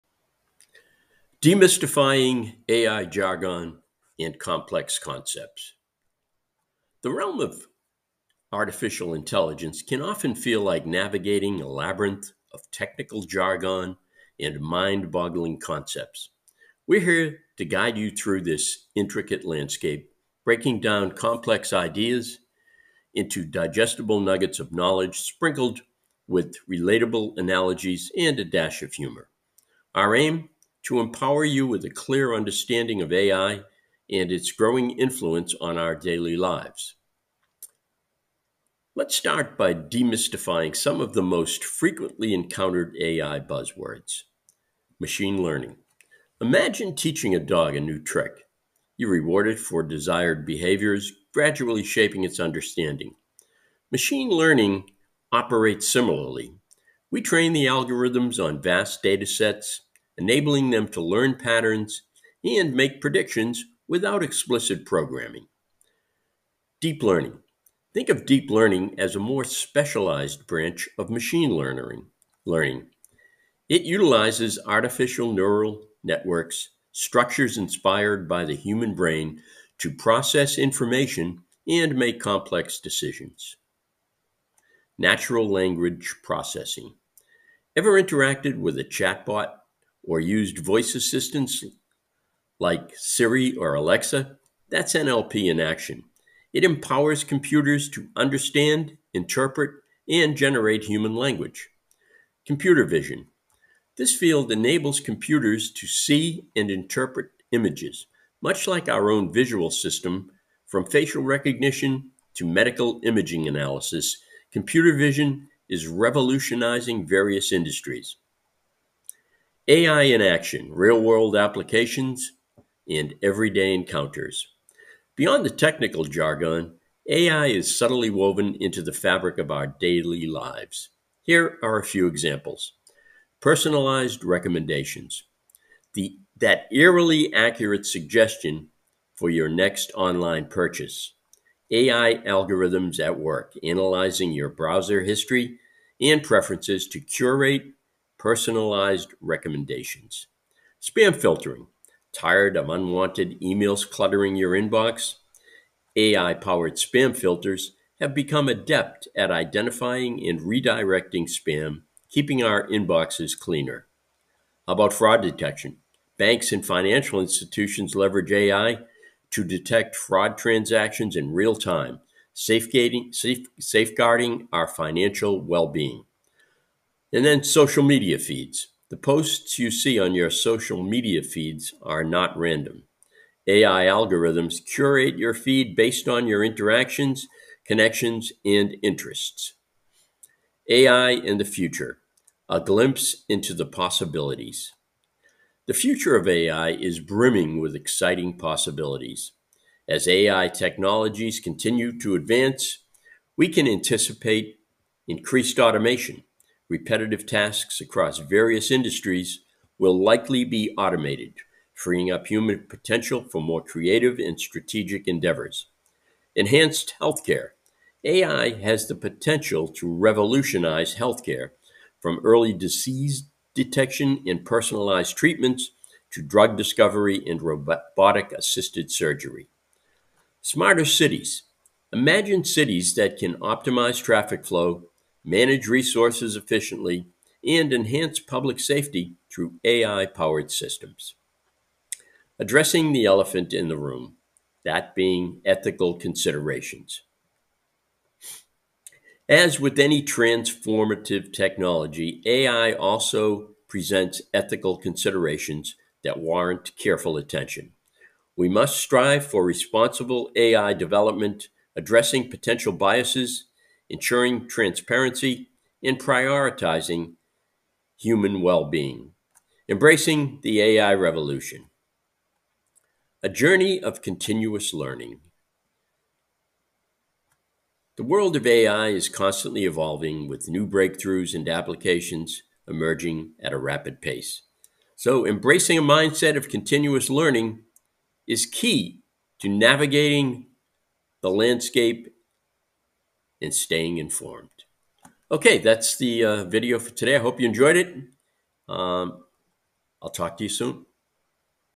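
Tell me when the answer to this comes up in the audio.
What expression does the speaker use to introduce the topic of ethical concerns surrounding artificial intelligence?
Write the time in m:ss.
4:03.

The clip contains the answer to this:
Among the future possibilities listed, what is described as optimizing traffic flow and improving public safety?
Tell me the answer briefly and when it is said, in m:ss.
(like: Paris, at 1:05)
Smarter cities, at 3:50.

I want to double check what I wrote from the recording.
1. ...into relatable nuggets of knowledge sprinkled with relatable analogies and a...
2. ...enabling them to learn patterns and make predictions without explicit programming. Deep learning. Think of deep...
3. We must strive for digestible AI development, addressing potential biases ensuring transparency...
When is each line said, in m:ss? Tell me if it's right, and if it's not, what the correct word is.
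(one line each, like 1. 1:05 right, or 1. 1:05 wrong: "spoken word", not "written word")
1. 0:23 wrong: "digestible", not "relatable"
2. 1:00 right
3. 4:18 wrong: "responsible", not "digestible".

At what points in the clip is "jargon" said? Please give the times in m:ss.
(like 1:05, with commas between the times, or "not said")
0:03, 0:13, 2:06.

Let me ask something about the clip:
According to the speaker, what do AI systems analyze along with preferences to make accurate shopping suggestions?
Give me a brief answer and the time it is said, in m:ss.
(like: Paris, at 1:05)
Browser history, at 2:24.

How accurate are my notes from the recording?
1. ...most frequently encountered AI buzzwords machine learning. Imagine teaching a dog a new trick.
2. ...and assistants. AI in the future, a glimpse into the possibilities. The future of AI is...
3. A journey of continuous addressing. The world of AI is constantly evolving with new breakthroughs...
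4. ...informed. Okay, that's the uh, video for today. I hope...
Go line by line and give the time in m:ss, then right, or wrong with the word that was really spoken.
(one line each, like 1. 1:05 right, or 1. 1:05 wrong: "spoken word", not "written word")
1. 0:41 right
2. 3:08 wrong: "interests", not "assistants"
3. 4:33 wrong: "learning", not "addressing"
4. 4:53 right.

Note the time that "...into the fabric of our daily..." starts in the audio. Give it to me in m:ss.
2:08.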